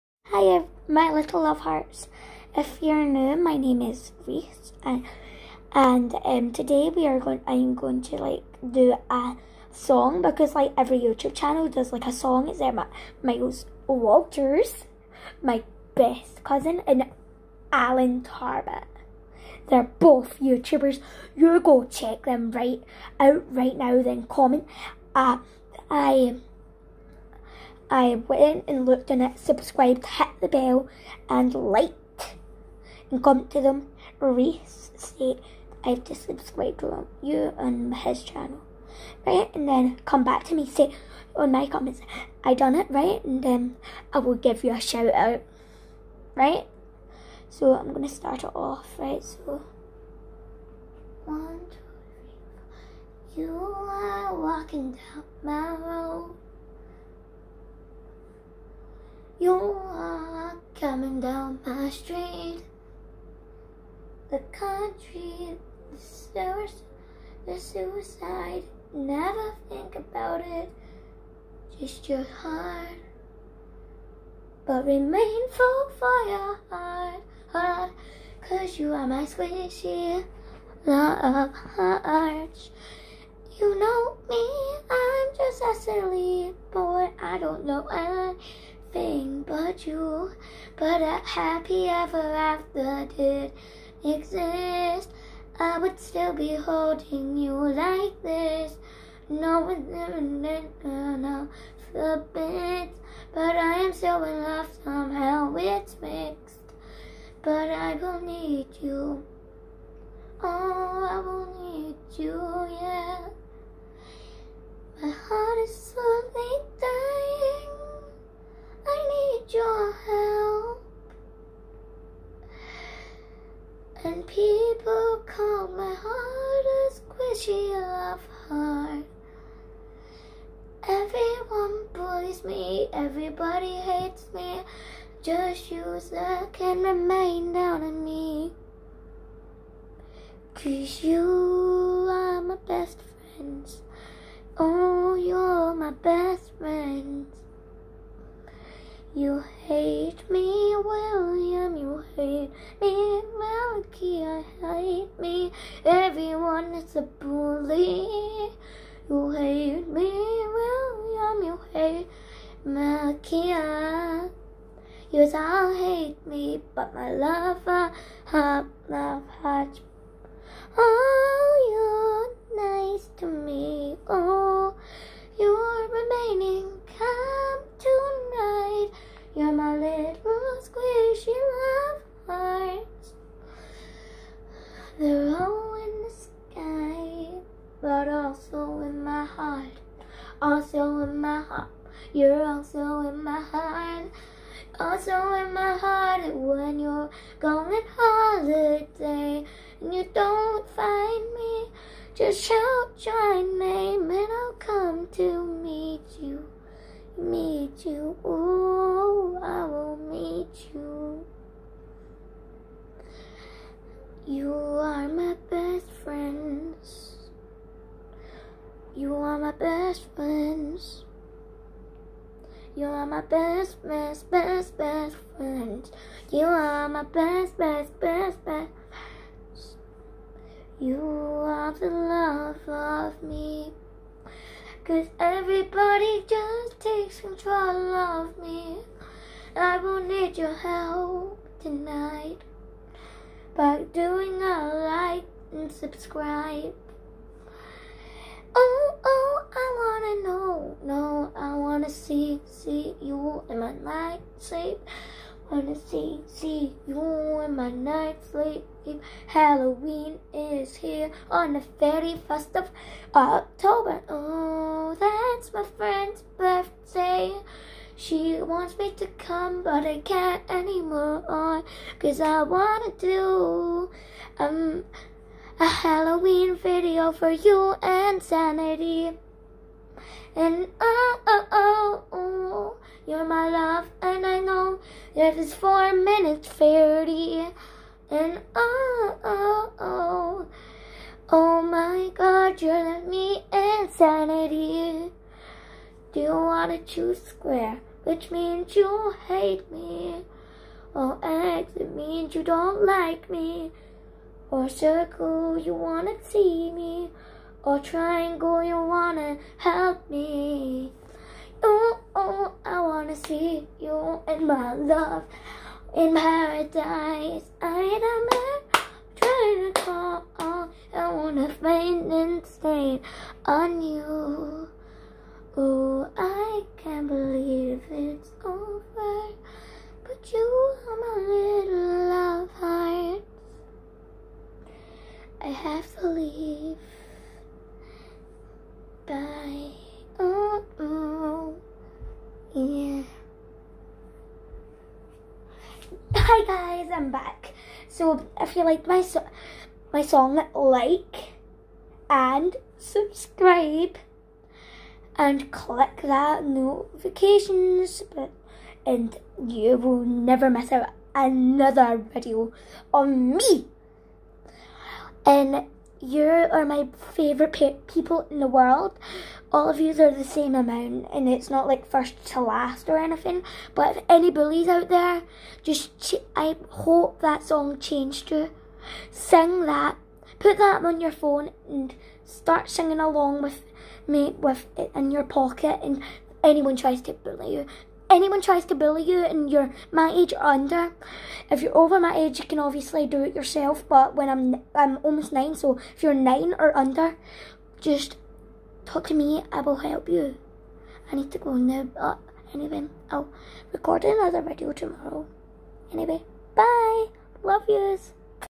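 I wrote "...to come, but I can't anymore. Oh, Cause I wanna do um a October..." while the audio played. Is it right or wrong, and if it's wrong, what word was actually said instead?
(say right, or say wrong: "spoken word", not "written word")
wrong: "Halloween", not "October".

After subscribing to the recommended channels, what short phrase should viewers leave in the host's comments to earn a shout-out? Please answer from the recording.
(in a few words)
I done it.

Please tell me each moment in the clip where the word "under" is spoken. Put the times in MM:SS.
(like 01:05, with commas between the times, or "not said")
06:30, 06:36.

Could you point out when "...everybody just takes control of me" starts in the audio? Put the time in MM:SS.
03:55.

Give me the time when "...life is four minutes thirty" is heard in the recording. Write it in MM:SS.
04:45.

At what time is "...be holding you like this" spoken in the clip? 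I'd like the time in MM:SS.
01:36.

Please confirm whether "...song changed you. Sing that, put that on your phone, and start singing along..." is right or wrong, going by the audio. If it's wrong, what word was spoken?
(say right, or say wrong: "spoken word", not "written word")
right.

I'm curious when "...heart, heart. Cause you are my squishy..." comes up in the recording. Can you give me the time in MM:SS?
01:16.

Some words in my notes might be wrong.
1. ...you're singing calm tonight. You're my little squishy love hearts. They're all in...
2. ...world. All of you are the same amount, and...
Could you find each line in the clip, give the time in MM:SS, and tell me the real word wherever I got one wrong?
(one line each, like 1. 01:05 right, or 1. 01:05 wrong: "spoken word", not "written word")
1. 02:55 wrong: "remaining", not "singing"
2. 06:08 right.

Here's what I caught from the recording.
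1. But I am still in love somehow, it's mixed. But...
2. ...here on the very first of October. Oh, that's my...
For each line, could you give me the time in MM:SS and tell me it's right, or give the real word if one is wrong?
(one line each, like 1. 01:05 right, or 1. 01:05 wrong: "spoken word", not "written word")
1. 01:43 right
2. 04:20 right.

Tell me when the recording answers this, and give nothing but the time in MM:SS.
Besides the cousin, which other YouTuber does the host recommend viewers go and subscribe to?
00:17.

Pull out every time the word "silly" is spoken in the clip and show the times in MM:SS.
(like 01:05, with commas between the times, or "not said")
01:25.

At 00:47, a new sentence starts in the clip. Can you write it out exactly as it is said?
So I'm gonna start it off, right?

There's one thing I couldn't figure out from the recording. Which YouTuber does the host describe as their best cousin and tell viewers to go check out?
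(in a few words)
Miles Walters.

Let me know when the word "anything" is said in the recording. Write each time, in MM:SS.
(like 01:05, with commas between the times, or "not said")
01:27, 06:12.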